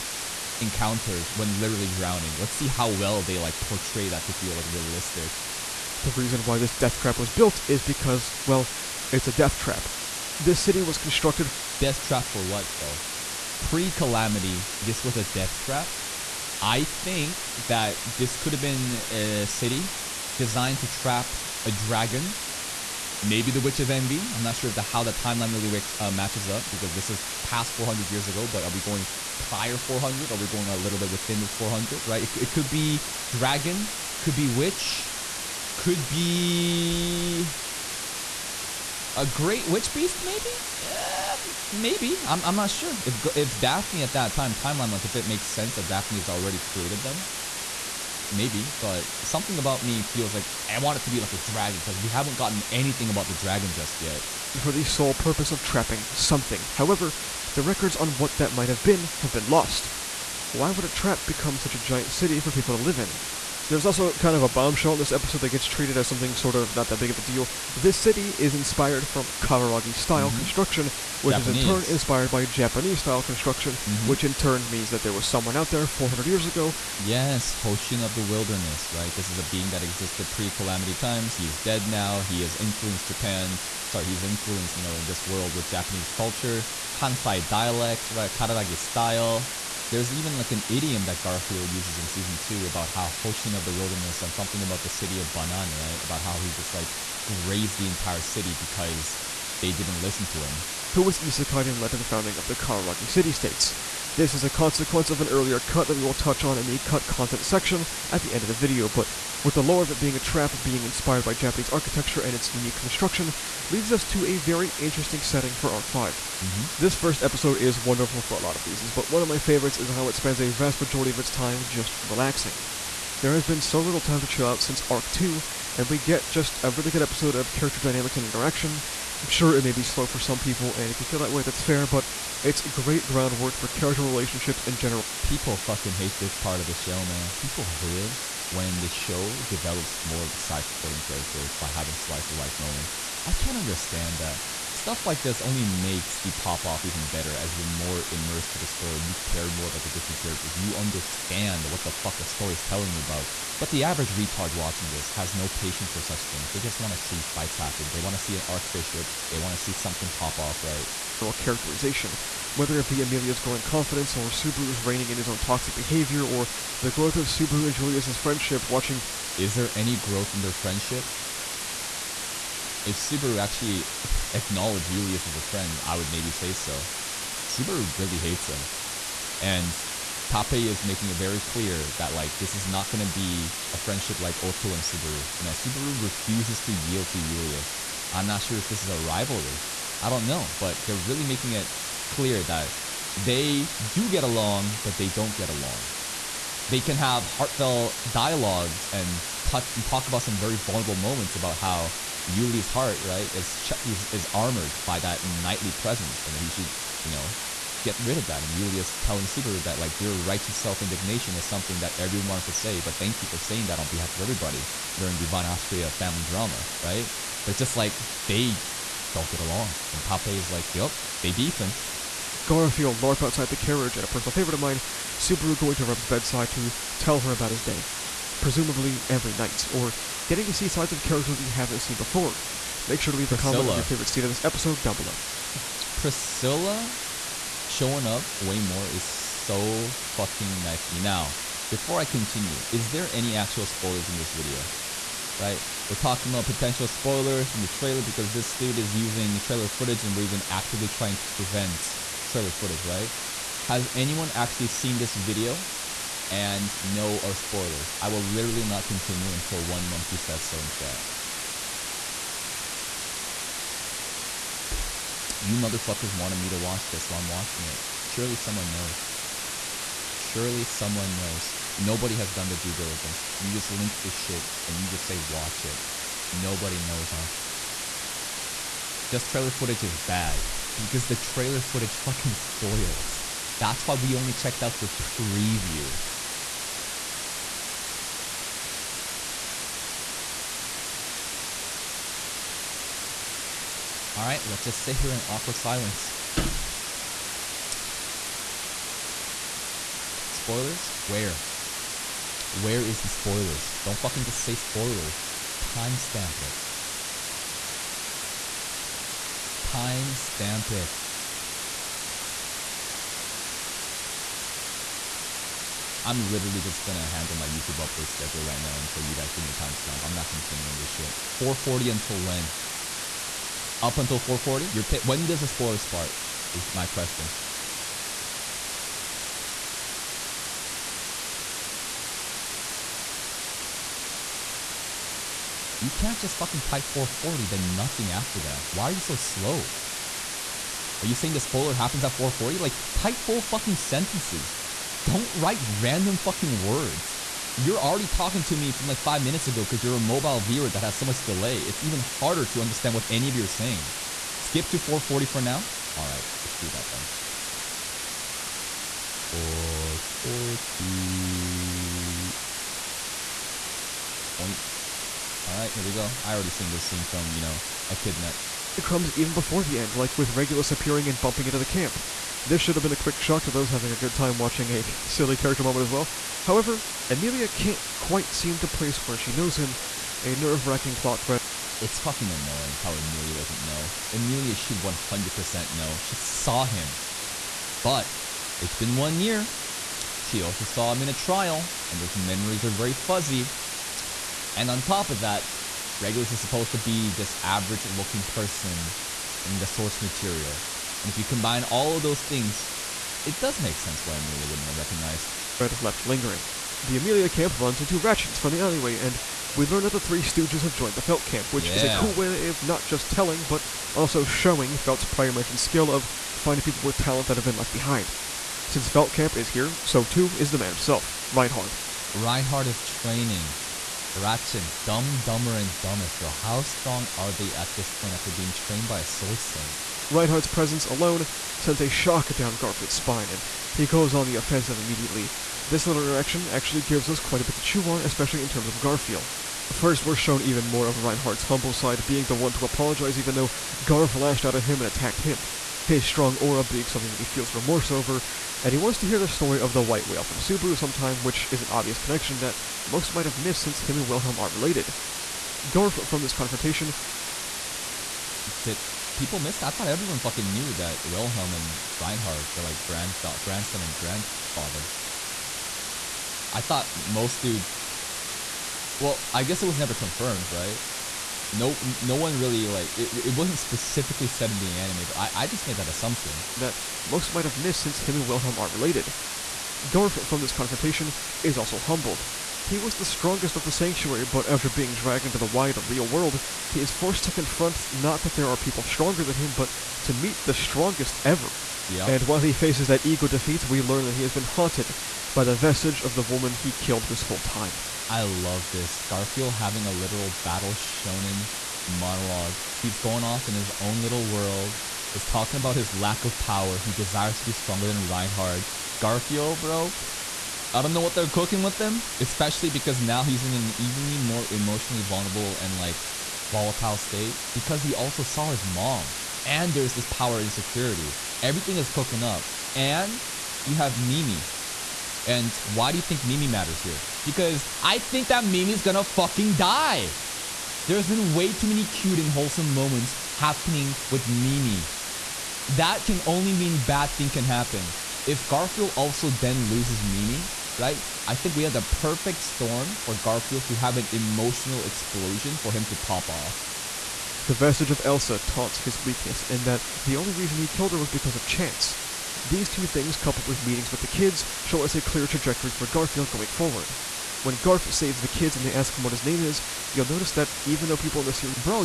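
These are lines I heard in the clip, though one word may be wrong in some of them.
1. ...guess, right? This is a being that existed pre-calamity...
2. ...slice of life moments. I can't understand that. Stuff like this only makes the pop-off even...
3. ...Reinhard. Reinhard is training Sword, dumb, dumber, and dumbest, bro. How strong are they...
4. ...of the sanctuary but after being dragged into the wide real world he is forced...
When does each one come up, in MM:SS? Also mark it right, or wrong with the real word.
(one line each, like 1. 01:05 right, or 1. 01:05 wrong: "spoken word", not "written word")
1. 01:18 wrong: "wilderness", not "guess"
2. 02:21 right
3. 07:01 wrong: "Rachins", not "Sword"
4. 08:03 right.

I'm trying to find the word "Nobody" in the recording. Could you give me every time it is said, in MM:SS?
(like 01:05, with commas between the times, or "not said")
04:31, 04:36.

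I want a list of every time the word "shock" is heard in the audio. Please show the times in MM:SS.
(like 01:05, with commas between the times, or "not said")
06:13, 07:11.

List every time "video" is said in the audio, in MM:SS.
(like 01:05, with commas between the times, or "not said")
01:48, 04:04, 04:15.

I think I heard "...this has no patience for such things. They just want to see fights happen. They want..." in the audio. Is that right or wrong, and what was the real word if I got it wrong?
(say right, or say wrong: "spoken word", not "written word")
right.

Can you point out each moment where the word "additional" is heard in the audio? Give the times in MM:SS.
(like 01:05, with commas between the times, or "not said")
not said.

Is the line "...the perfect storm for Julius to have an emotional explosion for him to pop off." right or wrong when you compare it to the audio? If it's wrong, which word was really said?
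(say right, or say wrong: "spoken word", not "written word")
wrong: "Garfield", not "Julius".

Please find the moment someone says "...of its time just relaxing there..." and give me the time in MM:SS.
02:01.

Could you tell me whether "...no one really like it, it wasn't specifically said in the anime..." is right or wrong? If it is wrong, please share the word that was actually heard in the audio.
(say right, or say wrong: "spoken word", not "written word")
right.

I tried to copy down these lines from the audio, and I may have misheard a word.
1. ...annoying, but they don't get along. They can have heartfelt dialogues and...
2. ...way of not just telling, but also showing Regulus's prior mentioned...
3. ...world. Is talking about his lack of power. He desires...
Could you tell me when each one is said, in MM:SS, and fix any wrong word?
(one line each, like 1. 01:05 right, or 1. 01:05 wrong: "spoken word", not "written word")
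1. 03:14 wrong: "along", not "annoying"
2. 06:52 wrong: "Felt", not "Regulus"
3. 08:24 right.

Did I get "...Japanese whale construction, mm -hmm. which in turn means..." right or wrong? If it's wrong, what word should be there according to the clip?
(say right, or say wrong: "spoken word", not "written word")
wrong: "style", not "whale".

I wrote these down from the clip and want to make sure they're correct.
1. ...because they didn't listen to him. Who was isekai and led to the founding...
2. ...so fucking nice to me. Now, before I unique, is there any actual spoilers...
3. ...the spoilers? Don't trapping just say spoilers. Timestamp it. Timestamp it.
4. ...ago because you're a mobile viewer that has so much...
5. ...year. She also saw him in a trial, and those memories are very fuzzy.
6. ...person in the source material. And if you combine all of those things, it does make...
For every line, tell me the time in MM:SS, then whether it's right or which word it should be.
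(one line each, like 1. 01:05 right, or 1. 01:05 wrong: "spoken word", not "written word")
1. 01:38 right
2. 03:59 wrong: "continue", not "unique"
3. 05:03 wrong: "fucking", not "trapping"
4. 05:49 right
5. 06:29 right
6. 06:38 right.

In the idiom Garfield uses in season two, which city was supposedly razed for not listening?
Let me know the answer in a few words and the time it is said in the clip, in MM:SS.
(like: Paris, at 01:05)
Banan, at 01:34.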